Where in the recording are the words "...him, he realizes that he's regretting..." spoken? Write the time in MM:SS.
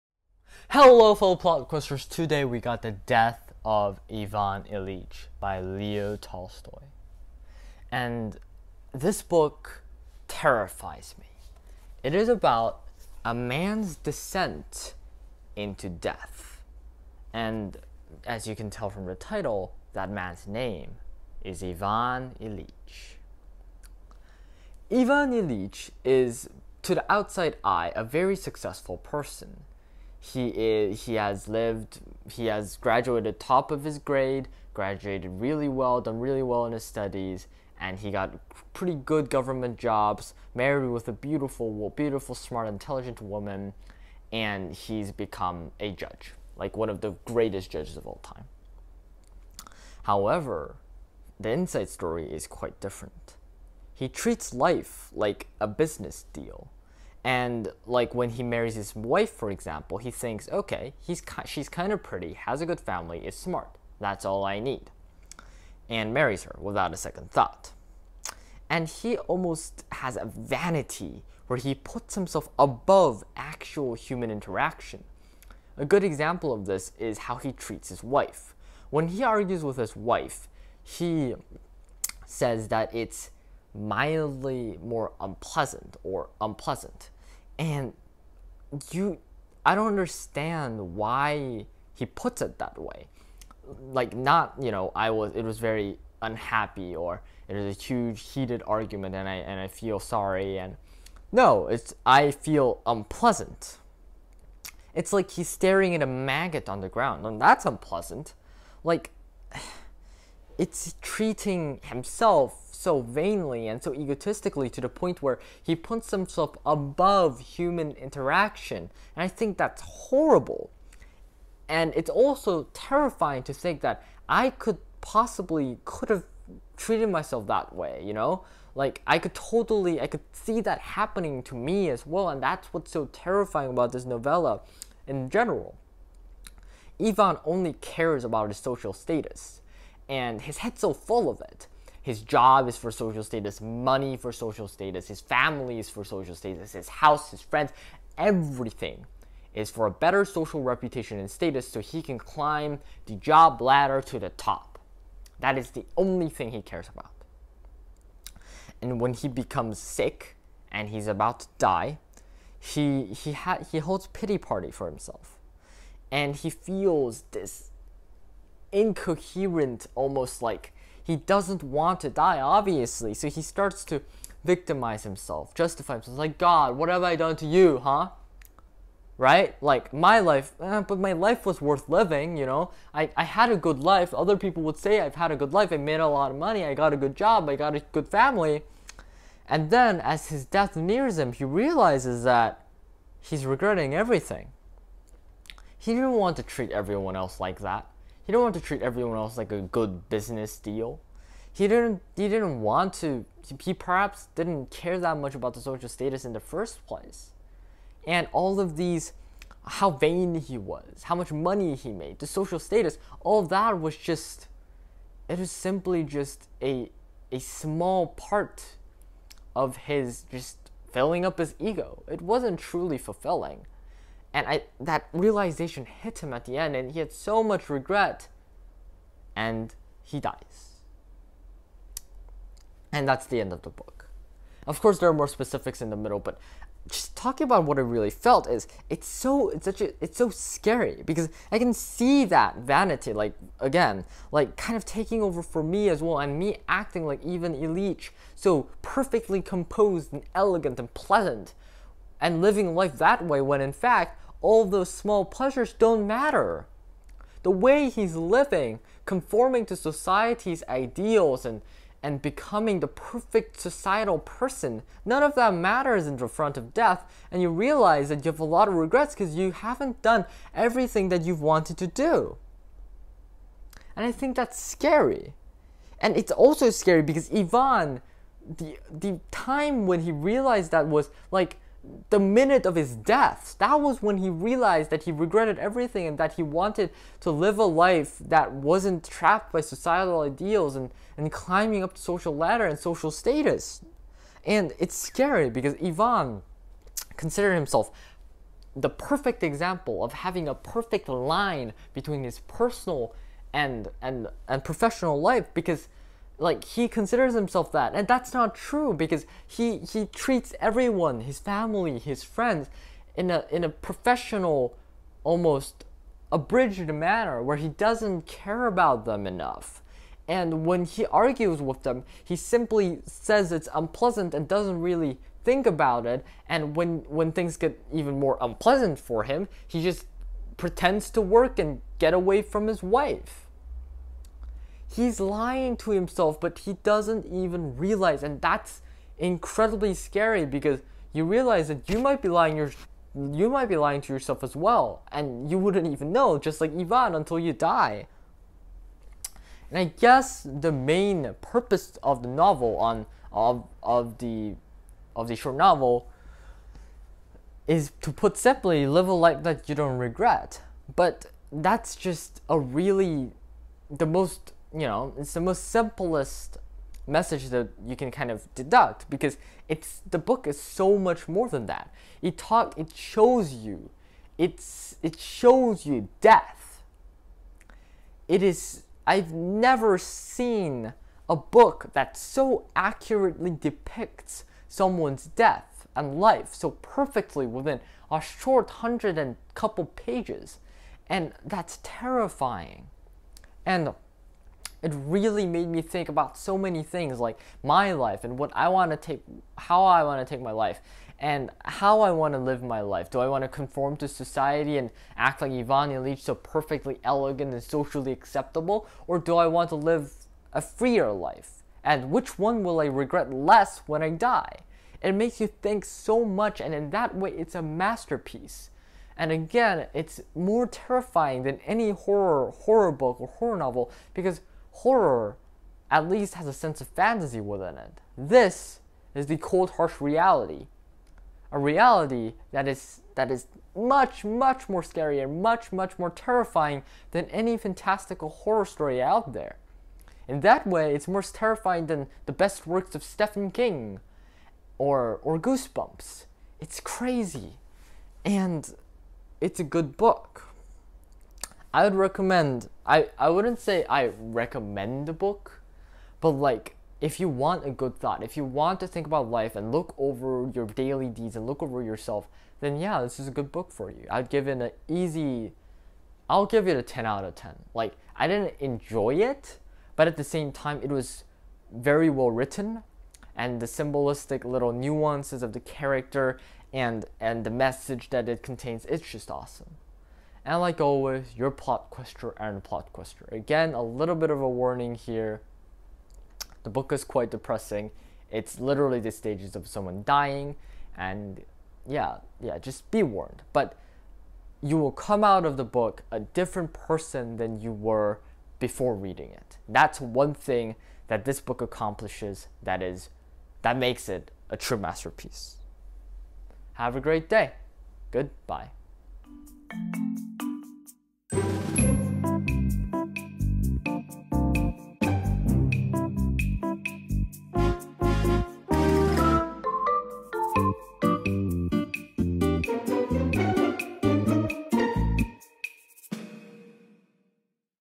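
03:11.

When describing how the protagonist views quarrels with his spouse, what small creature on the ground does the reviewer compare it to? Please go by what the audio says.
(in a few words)
maggot.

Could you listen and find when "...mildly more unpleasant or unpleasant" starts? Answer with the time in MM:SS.
01:23.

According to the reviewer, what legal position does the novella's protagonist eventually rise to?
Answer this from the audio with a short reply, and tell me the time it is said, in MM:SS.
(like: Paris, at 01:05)
a judge, at 00:45.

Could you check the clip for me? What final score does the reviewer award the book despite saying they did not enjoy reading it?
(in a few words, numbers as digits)
10 out of 10.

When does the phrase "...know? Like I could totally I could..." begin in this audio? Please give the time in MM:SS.
02:08.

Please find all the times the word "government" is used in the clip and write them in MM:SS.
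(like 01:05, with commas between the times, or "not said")
00:39.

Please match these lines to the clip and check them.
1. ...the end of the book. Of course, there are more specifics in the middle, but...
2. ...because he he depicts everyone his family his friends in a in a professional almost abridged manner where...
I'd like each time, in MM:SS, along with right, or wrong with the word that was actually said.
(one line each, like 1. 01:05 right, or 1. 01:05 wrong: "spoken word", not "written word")
1. 03:53 right
2. 05:08 wrong: "treats", not "depicts".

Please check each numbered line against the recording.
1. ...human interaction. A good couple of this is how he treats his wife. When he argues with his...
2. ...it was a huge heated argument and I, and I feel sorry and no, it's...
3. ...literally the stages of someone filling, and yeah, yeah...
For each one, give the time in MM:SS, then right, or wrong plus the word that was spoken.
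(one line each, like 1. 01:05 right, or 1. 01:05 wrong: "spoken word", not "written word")
1. 01:13 wrong: "example", not "couple"
2. 01:37 right
3. 08:08 wrong: "dying", not "filling".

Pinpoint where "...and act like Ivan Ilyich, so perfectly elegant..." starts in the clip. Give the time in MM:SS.
06:44.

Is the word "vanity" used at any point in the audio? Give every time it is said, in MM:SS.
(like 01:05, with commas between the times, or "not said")
01:10, 04:02.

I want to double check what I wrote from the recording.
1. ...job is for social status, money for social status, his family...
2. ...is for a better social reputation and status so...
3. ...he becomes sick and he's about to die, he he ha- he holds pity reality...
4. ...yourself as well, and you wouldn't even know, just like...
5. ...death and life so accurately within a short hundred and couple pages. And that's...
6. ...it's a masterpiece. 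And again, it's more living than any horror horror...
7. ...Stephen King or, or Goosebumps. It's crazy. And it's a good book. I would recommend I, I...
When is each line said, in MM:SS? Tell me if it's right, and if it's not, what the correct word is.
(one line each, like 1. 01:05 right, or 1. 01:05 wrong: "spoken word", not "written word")
1. 02:22 right
2. 02:29 right
3. 02:39 wrong: "party", not "reality"
4. 05:44 right
5. 06:25 wrong: "perfectly", not "accurately"
6. 06:57 wrong: "terrifying", not "living"
7. 07:23 right.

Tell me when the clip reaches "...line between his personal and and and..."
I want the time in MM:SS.
05:01.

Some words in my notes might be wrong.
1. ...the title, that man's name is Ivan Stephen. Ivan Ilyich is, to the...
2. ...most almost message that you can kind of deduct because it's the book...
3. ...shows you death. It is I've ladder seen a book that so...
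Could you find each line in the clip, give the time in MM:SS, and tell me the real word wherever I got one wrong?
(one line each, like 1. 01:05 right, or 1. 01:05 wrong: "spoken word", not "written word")
1. 00:19 wrong: "Ilyich", not "Stephen"
2. 06:05 wrong: "simplest", not "almost"
3. 06:15 wrong: "never", not "ladder".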